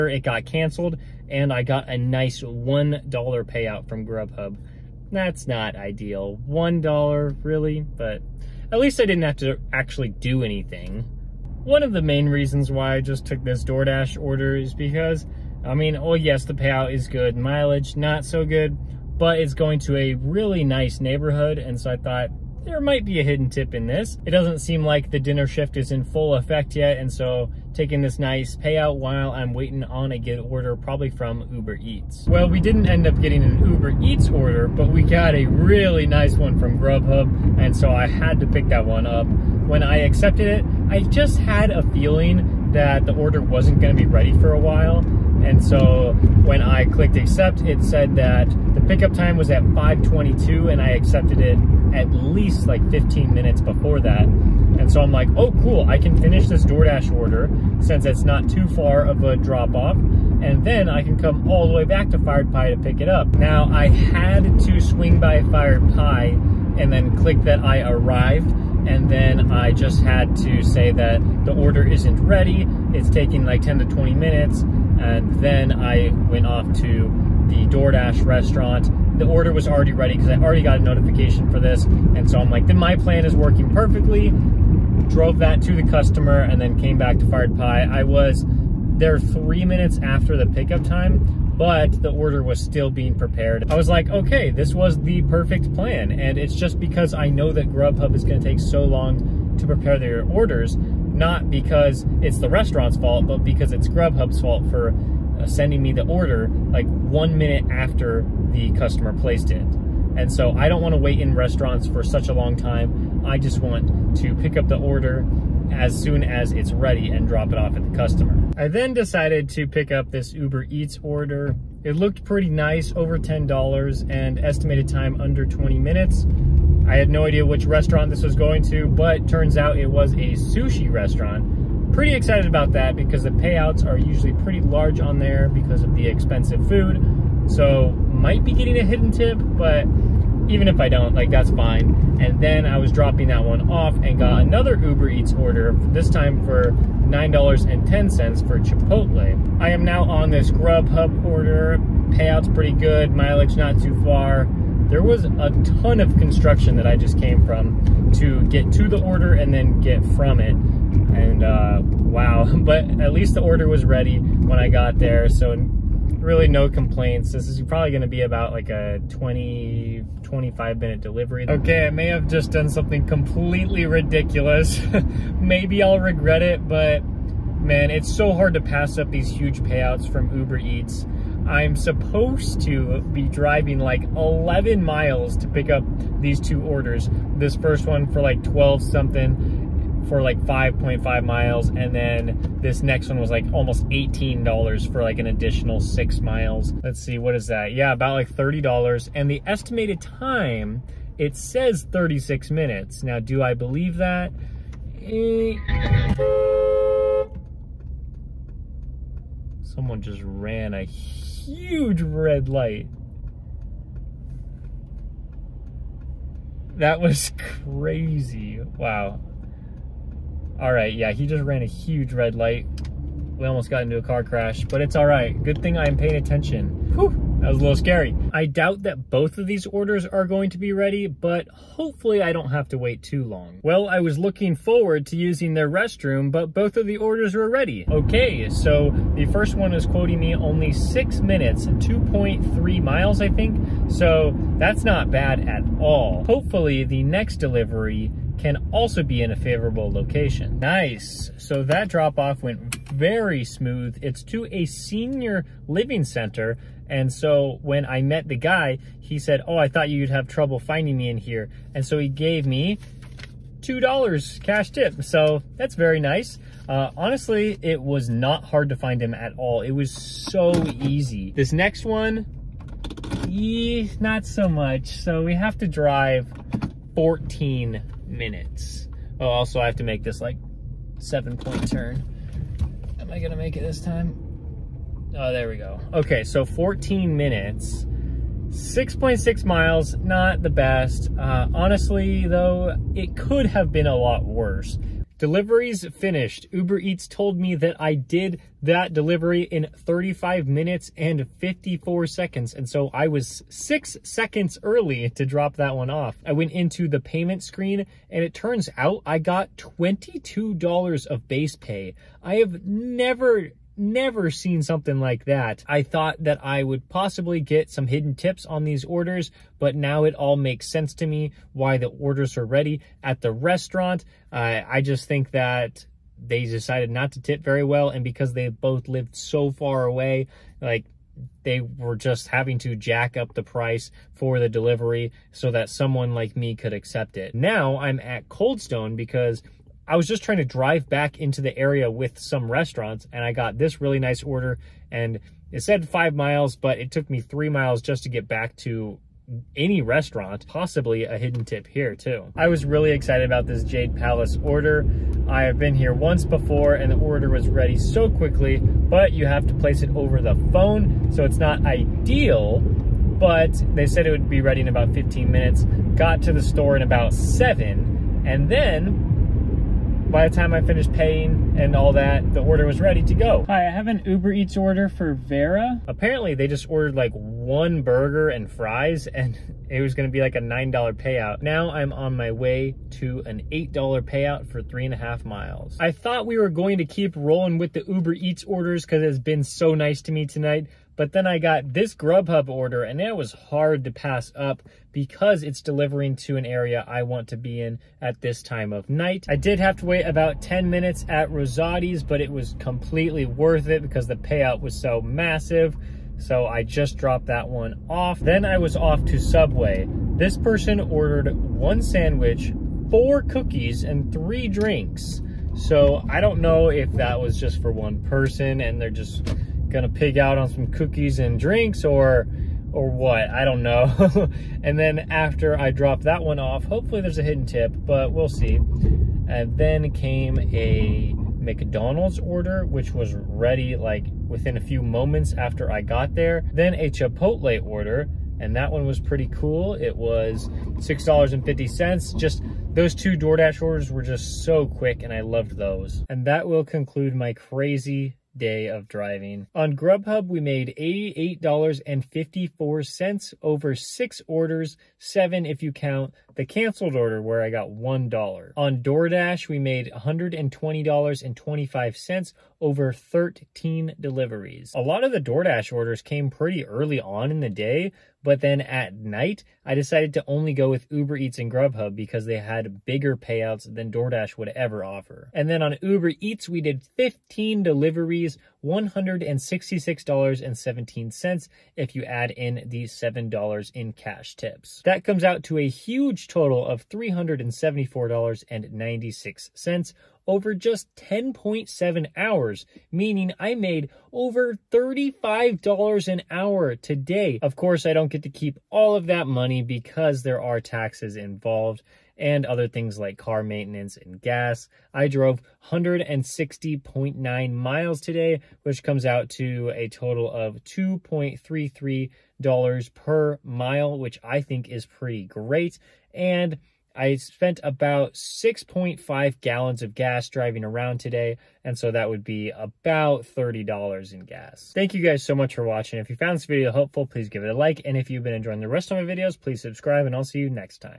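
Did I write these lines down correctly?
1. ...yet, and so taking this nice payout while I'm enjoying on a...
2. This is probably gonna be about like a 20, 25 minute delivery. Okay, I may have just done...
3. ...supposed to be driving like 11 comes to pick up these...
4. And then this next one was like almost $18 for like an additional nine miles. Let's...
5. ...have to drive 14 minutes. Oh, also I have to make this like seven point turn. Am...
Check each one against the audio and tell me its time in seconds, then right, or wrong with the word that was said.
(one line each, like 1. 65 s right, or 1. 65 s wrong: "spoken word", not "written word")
1. 26 s wrong: "waiting", not "enjoying"
2. 167 s right
3. 181 s wrong: "miles", not "comes"
4. 191 s wrong: "six", not "nine"
5. 275 s right.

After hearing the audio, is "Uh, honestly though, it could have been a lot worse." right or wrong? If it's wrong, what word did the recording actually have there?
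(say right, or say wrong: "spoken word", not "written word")
right.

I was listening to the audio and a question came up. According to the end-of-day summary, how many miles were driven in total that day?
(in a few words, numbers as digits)
160.9 miles.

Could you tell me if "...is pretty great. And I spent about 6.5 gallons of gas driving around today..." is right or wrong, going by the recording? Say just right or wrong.
right.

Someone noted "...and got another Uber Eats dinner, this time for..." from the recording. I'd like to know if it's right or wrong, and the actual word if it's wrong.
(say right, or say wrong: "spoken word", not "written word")
wrong: "order", not "dinner".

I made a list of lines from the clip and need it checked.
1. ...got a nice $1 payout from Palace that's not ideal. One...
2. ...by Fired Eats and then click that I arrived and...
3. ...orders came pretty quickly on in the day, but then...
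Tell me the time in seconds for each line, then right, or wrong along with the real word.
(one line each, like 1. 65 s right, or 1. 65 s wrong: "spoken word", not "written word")
1. 1 s wrong: "Grubhub", not "Palace"
2. 65 s wrong: "Pie", not "Eats"
3. 465 s wrong: "early", not "quickly".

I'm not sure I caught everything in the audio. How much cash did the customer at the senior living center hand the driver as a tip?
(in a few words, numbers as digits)
$2.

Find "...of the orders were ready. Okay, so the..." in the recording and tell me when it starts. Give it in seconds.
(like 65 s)
236 s.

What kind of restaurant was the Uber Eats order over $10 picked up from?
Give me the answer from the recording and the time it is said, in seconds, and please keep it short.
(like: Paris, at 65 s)
Sushi restaurant, at 130 s.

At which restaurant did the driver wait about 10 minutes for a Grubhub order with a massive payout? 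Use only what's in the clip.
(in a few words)
Rosati's.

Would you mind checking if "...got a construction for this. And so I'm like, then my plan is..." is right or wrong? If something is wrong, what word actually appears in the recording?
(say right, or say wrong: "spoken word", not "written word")
wrong: "notification", not "construction".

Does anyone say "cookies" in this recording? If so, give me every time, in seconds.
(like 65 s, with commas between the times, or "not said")
413 s, 420 s.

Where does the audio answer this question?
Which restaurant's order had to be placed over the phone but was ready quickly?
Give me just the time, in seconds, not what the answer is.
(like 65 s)
353 s.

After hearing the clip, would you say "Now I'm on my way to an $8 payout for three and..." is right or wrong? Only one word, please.
right.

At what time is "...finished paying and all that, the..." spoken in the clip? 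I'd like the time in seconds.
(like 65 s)
370 s.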